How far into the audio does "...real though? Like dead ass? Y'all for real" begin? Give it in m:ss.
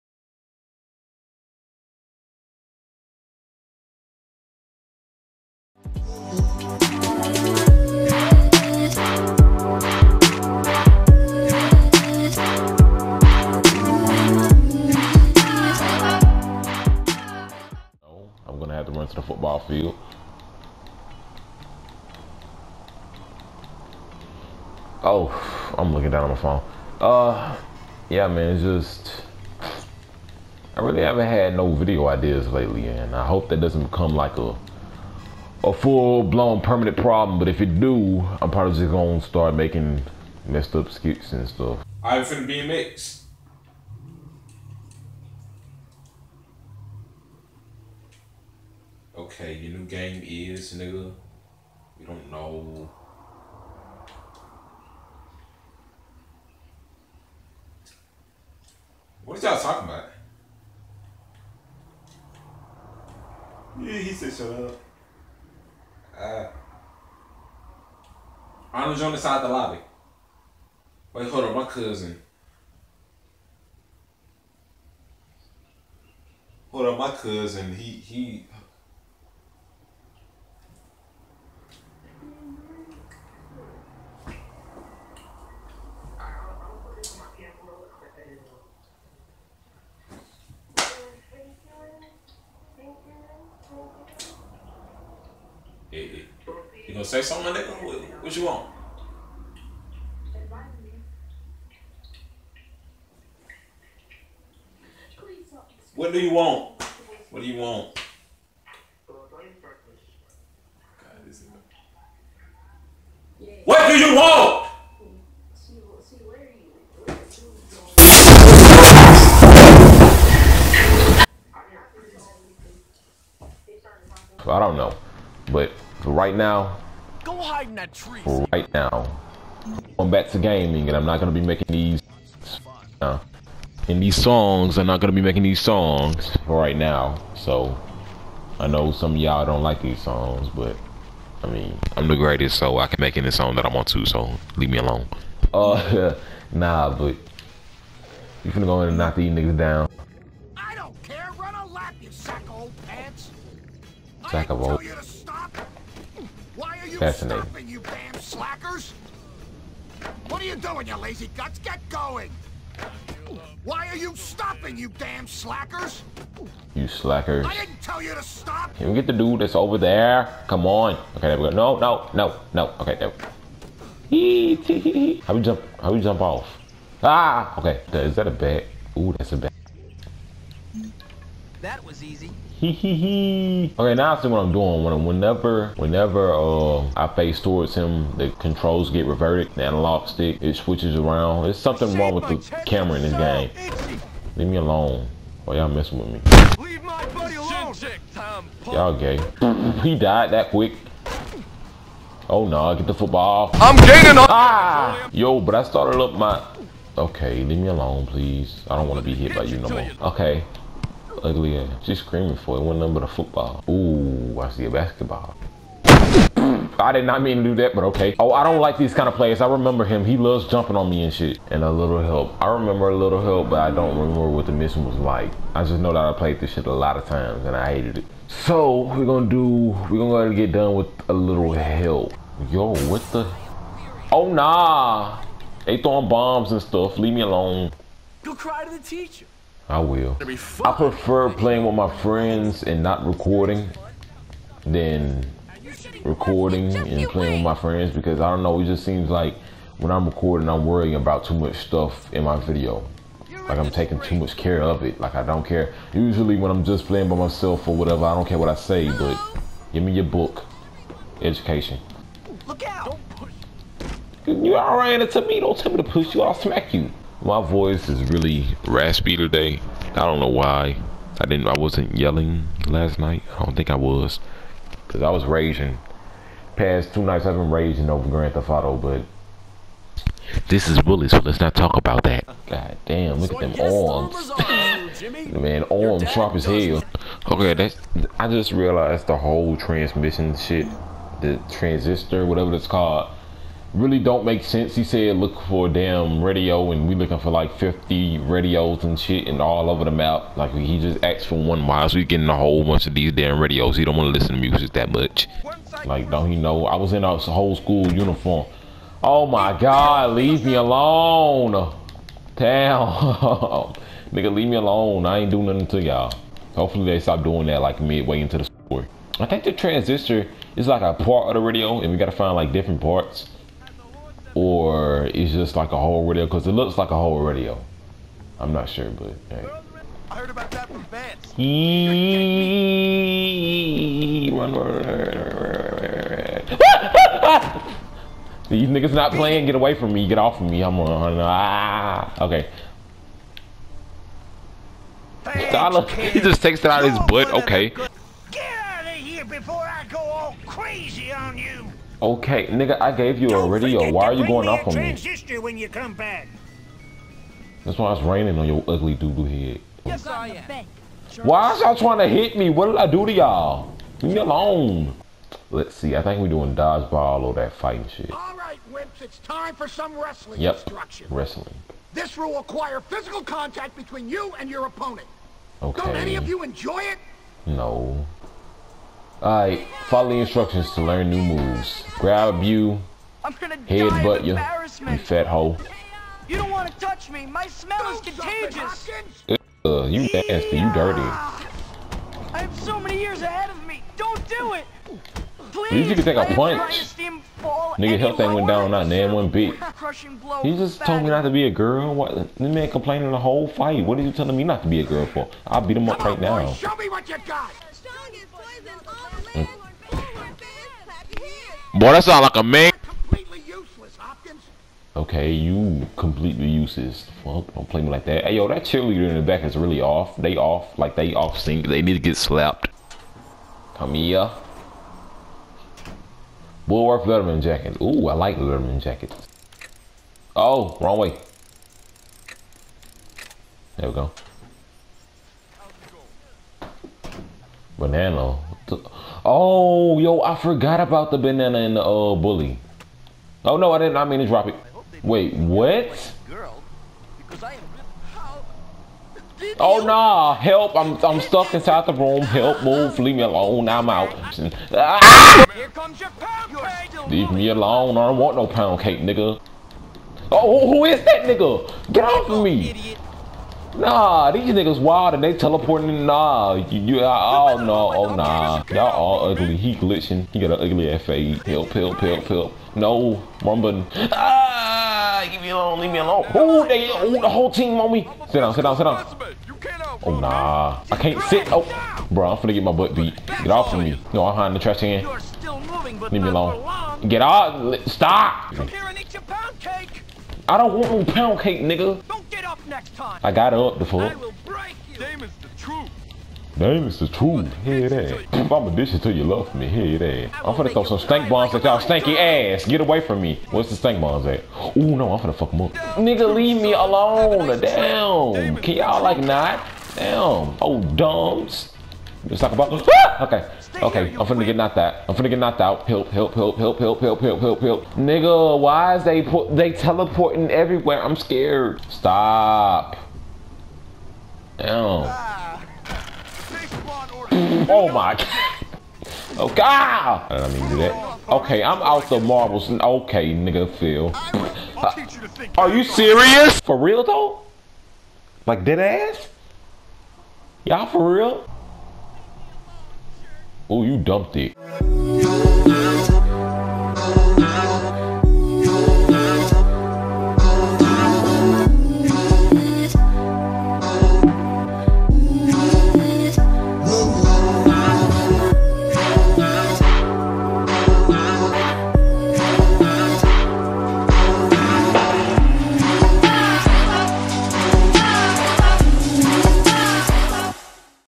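8:56.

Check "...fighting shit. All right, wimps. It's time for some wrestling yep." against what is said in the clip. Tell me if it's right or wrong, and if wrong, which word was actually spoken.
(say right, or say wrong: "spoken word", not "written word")
right.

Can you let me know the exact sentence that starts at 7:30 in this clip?
I'm I'm stuck inside the room.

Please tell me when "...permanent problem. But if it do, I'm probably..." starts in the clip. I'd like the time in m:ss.
0:36.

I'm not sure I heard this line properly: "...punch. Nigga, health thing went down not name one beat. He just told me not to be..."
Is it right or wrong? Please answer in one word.
right.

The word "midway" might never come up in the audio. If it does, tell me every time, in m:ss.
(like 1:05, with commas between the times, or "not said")
5:17.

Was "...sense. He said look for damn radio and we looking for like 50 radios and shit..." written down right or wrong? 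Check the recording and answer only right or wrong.
right.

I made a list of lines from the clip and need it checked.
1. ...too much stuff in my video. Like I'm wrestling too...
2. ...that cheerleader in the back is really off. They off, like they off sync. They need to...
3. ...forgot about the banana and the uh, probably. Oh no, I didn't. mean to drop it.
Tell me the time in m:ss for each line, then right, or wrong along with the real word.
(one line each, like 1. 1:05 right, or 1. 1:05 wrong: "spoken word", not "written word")
1. 4:11 wrong: "taking", not "wrestling"
2. 6:58 right
3. 7:20 wrong: "bully", not "probably".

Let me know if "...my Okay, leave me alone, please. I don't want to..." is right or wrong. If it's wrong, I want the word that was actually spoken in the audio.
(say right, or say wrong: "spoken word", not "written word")
right.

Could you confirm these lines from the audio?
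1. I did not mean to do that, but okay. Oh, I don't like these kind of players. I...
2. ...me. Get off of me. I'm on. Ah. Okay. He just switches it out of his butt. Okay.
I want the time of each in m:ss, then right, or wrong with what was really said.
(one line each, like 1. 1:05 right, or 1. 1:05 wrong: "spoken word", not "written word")
1. 3:36 right
2. 5:39 wrong: "takes", not "switches".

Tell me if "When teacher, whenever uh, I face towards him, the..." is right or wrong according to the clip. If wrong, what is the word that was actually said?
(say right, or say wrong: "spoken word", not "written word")
wrong: "whenever", not "teacher".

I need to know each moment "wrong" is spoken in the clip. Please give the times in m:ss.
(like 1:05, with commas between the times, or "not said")
3:11, 7:10.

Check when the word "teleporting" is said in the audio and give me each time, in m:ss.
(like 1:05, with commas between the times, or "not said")
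7:45, 8:39.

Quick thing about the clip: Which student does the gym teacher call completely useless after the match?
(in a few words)
Hopkins.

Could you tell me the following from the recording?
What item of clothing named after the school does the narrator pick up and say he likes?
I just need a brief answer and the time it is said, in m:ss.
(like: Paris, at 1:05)
Bullworth Letterman jacket, at 7:06.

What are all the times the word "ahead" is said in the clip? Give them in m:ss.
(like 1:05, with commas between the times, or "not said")
3:50, 6:33.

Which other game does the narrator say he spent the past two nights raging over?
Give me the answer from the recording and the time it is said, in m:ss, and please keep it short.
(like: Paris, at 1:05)
Grand Theft Auto, at 4:38.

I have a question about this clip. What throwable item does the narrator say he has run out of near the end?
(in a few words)
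Marbles.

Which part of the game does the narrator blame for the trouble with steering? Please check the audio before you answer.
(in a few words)
The camera.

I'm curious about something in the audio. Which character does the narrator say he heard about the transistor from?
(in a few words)
Vance.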